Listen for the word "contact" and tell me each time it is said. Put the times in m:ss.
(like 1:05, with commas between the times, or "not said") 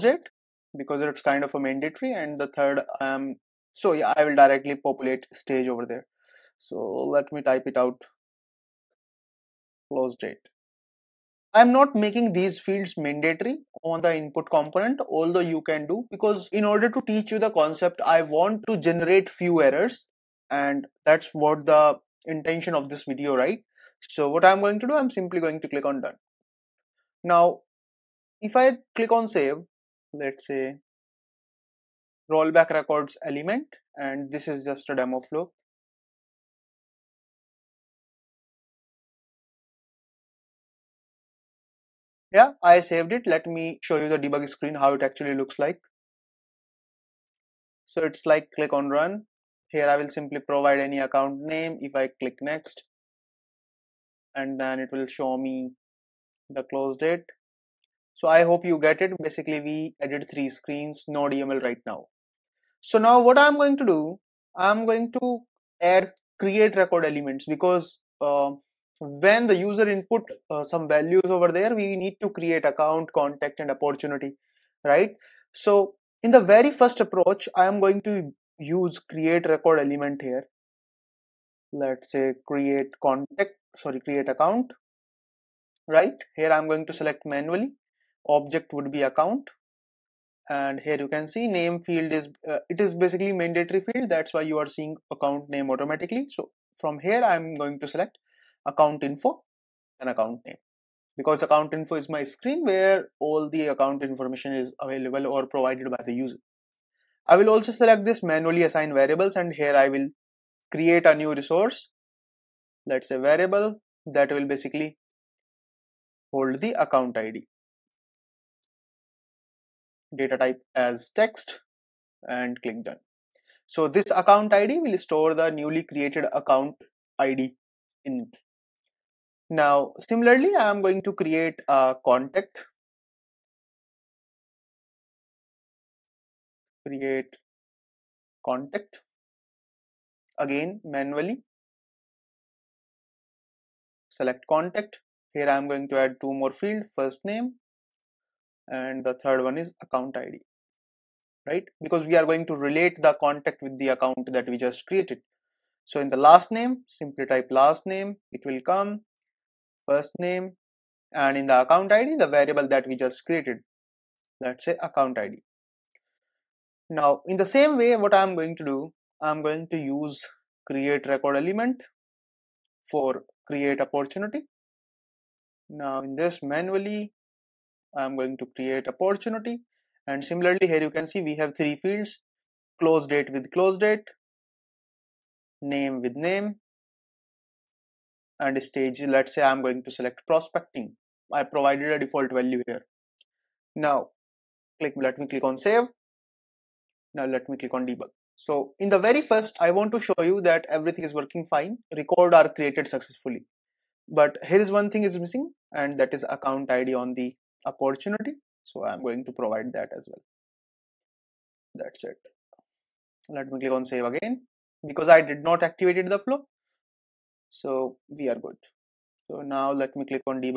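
1:13, 1:23, 2:12, 2:18, 2:24, 2:33.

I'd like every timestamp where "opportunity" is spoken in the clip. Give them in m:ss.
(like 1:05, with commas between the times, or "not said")
1:13, 2:53, 2:58, 3:27.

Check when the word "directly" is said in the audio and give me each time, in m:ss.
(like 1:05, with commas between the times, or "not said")
0:04.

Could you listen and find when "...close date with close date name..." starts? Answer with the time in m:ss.
3:02.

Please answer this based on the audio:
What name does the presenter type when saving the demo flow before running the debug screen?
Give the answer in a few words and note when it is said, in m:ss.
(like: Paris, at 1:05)
Rollback records element, at 0:32.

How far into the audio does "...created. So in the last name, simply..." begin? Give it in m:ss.
2:34.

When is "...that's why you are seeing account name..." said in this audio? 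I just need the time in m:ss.
1:34.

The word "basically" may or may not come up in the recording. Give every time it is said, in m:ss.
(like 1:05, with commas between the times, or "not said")
0:59, 1:32, 1:54.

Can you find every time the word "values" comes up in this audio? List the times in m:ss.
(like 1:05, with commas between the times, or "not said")
1:10, 3:12.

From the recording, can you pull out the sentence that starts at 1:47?
I will also select this manually assign variables and here I will create a new resource.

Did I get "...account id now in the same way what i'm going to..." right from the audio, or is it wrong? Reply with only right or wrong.
right.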